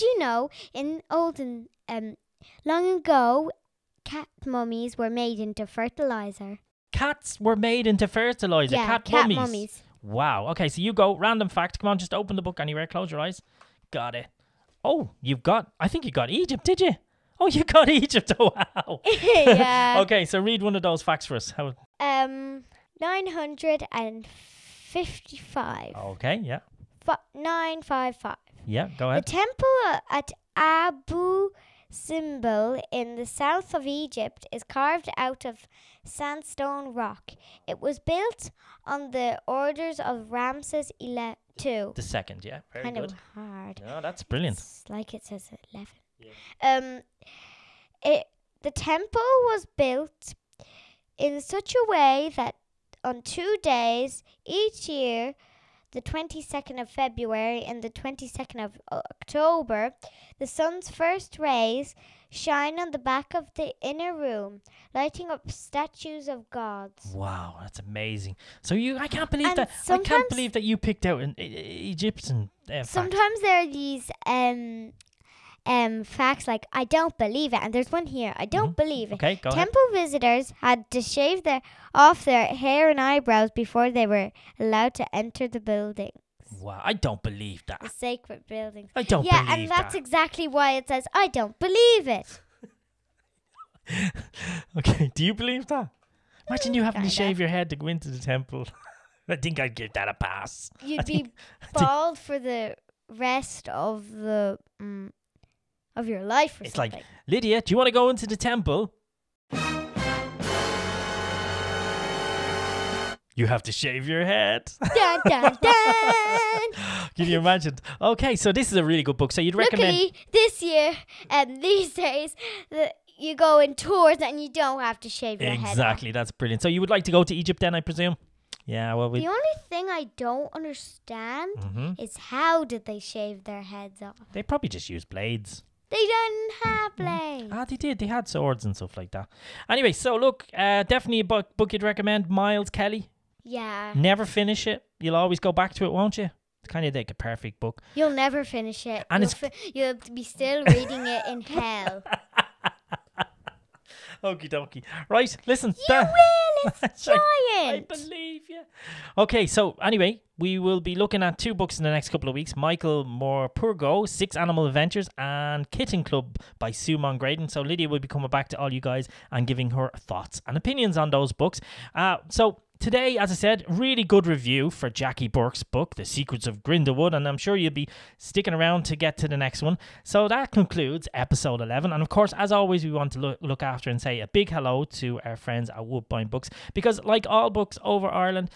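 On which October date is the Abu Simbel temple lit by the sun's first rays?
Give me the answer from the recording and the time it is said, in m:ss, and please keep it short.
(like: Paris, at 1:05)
22nd of October, at 0:57.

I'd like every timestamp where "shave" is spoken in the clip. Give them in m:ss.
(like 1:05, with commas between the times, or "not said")
1:21, 1:37, 1:53, 2:05, 2:12.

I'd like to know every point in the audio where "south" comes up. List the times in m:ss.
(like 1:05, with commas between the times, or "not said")
0:33.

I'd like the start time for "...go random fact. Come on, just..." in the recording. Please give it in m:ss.
0:10.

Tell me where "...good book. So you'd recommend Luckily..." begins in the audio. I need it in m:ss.
1:59.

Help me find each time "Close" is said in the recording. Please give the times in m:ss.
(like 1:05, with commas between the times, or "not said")
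0:12.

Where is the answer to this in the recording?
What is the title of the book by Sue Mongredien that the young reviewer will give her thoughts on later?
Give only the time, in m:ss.
2:45.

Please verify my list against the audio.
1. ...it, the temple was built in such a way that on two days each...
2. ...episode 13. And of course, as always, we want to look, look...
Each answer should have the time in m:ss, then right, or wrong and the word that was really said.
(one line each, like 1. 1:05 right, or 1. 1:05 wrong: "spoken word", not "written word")
1. 0:48 right
2. 3:01 wrong: "11", not "13".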